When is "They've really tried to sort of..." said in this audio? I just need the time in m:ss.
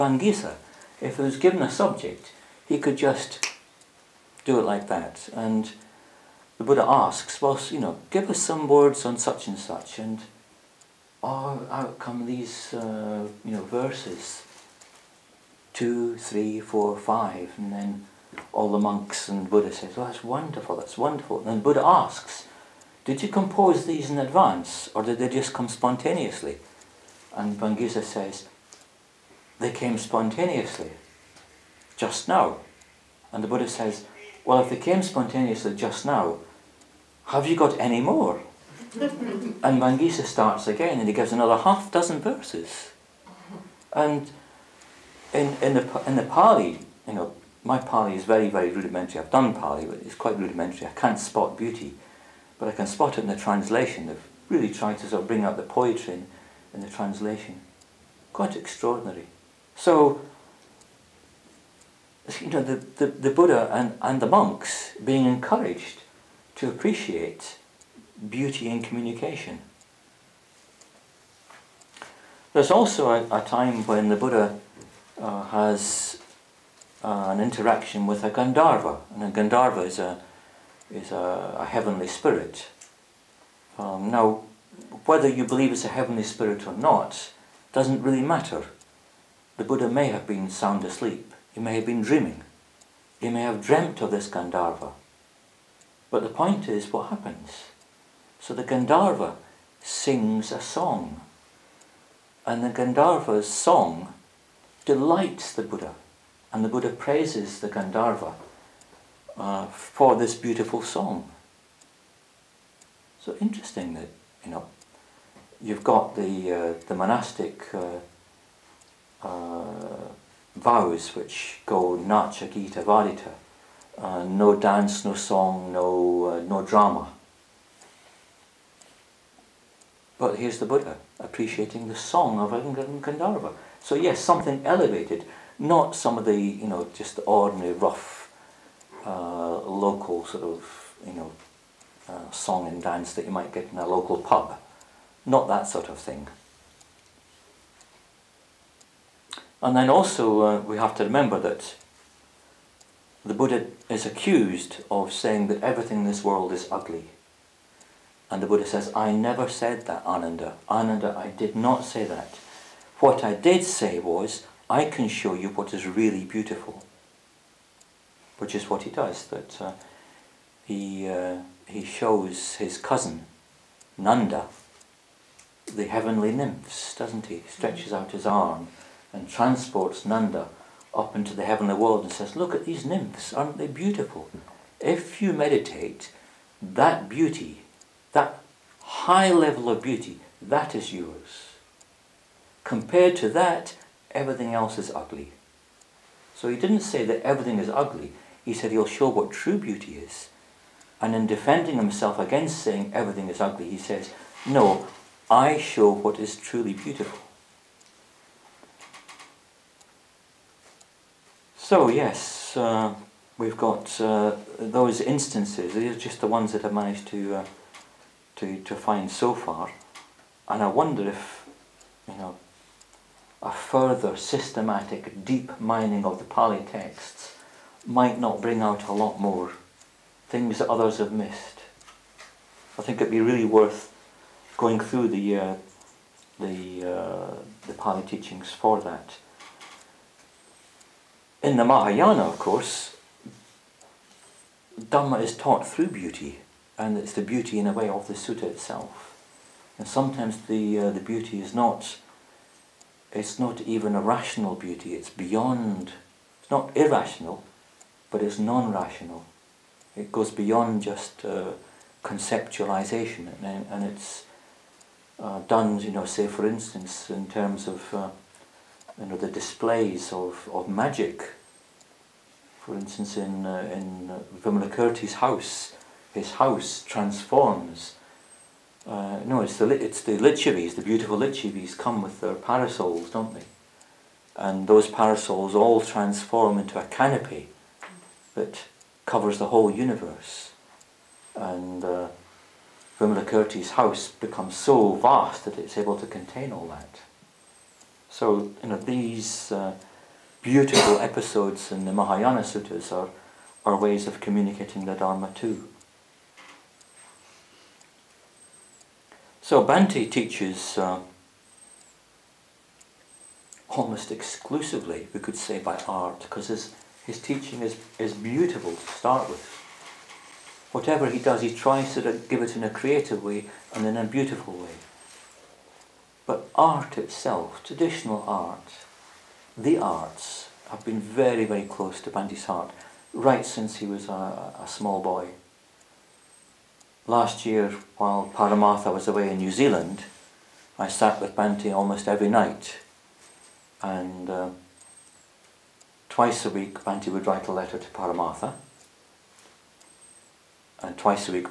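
0:54.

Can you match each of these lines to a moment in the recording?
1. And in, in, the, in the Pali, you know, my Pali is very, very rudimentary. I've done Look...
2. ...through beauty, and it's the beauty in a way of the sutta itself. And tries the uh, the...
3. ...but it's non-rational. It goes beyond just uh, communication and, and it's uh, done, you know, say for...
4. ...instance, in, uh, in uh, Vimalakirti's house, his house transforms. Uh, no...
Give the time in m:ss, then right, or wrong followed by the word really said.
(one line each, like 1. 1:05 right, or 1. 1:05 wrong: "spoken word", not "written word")
1. 0:43 wrong: "Pali", not "Look"
2. 4:05 wrong: "sometimes", not "tries"
3. 4:18 wrong: "conceptualization", not "communication"
4. 4:32 right.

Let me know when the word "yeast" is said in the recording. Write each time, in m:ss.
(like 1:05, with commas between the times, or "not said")
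not said.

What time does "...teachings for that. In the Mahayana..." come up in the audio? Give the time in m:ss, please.
3:58.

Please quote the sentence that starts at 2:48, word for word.
Which is what he does, that uh, he uh, he shows his cousin, Nanda, the heavenly nymphs, doesn't he?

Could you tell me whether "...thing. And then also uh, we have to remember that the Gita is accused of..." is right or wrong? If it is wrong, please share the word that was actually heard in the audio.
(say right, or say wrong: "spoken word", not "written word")
wrong: "Buddha", not "Gita".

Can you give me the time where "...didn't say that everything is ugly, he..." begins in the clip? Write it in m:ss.
3:16.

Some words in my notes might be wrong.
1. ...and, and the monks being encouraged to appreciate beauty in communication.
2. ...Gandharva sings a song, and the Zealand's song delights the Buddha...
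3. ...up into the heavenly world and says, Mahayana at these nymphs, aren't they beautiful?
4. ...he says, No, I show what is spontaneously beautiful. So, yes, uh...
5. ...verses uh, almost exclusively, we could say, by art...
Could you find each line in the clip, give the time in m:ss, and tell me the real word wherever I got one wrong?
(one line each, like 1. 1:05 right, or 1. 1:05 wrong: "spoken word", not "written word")
1. 1:03 right
2. 1:38 wrong: "Gandharva", not "Zealand"
3. 3:00 wrong: "Look", not "Mahayana"
4. 3:23 wrong: "truly", not "spontaneously"
5. 5:10 wrong: "teaches", not "verses".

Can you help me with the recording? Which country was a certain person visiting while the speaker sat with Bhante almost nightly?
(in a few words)
New Zealand.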